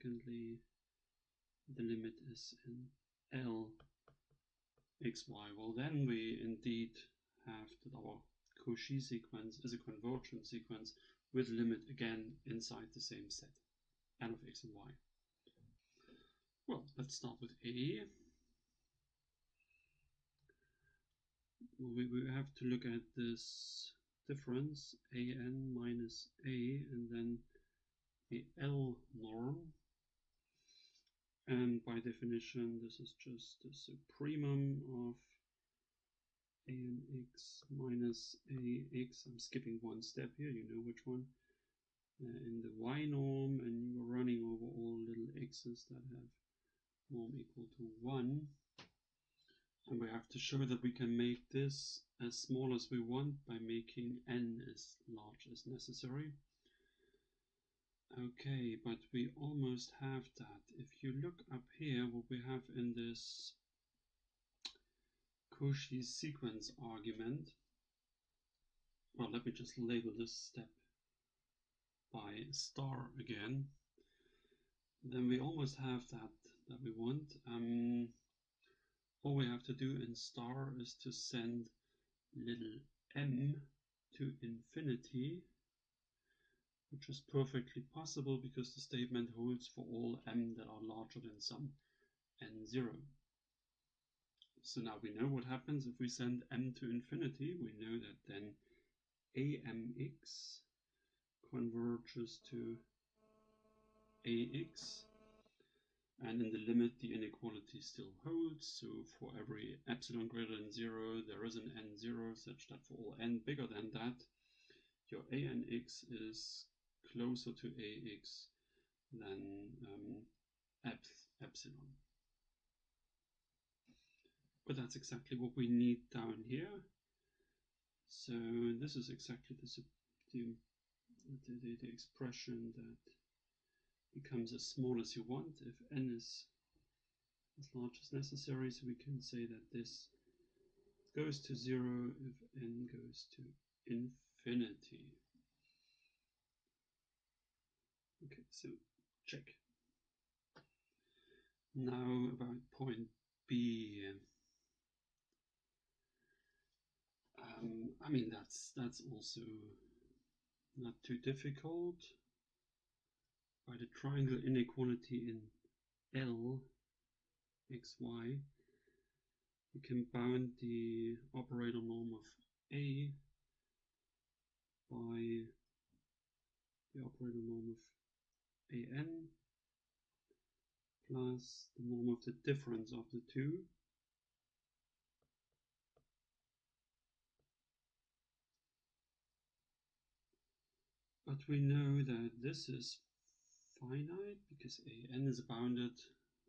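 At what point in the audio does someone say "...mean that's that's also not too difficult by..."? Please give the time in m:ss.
2:38.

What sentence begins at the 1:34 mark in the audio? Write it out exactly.
So now we know what happens if we send m to infinity.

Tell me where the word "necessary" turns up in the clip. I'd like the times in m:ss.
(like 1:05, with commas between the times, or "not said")
0:55, 2:18.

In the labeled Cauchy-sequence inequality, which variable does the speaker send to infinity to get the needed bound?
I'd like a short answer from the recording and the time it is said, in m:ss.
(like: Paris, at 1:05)
little m, at 1:22.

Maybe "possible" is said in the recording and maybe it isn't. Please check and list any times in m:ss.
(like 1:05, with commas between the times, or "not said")
1:27.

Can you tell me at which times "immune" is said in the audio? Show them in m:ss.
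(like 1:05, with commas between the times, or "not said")
not said.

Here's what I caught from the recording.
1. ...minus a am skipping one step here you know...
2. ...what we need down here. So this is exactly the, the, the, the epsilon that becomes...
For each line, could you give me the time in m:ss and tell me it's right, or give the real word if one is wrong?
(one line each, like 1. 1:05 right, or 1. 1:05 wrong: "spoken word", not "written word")
1. 0:37 right
2. 2:05 wrong: "expression", not "epsilon".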